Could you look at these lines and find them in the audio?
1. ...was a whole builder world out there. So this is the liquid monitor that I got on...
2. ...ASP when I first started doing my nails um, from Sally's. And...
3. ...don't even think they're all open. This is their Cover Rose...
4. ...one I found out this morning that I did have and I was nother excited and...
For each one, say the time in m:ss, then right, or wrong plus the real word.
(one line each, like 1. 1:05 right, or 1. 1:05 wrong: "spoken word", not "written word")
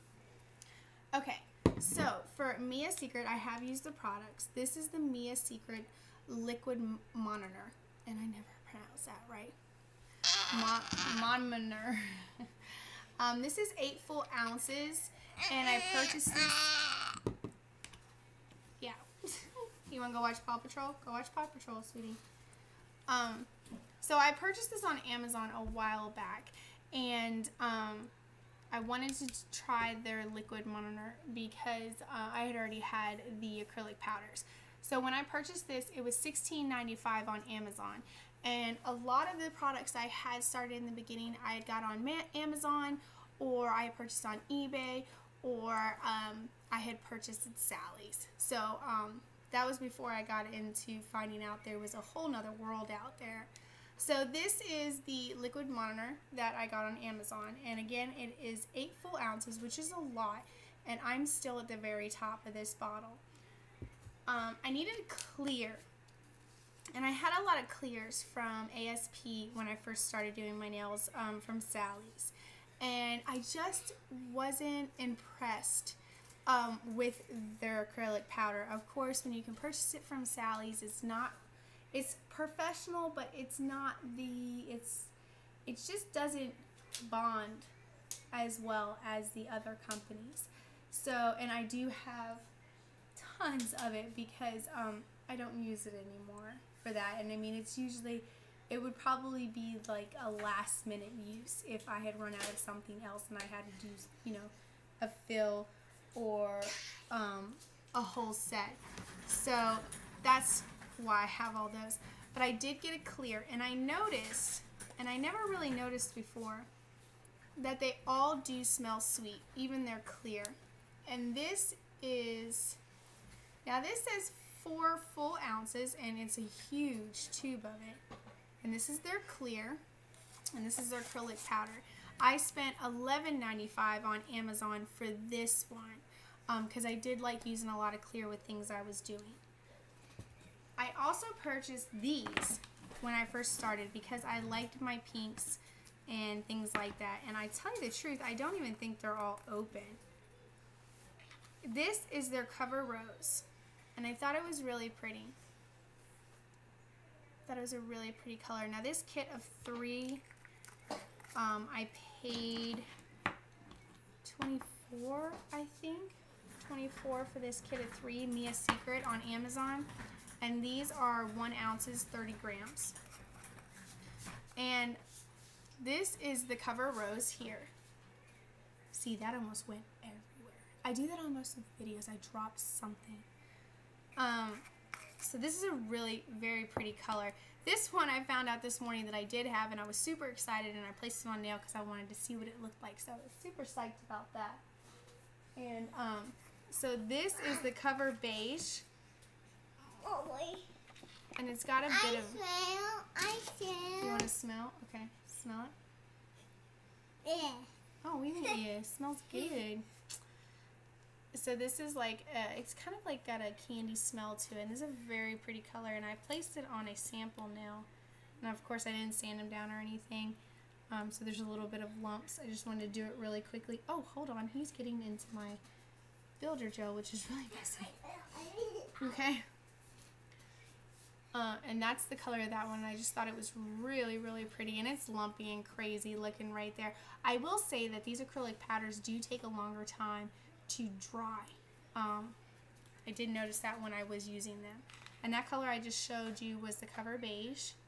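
1. 0:51 wrong: "nother", not "builder"
2. 1:08 right
3. 2:28 right
4. 3:07 wrong: "super", not "nother".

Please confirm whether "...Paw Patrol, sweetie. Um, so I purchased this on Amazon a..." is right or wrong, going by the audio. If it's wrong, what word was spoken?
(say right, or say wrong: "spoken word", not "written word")
right.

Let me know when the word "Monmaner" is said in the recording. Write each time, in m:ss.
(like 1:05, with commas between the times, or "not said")
0:11.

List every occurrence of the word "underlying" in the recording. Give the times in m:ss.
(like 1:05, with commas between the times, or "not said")
not said.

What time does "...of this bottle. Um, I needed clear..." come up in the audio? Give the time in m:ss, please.
1:02.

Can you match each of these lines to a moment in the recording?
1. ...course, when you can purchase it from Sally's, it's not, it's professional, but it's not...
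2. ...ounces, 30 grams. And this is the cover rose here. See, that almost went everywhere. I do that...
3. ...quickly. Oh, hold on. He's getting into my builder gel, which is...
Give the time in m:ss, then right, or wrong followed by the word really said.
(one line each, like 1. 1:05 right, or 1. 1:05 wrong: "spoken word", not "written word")
1. 1:18 right
2. 2:51 right
3. 3:43 right.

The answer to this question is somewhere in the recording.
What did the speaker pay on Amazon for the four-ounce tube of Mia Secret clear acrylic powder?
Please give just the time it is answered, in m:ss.
2:12.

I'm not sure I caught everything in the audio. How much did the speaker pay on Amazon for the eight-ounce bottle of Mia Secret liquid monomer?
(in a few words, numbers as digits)
$16.95.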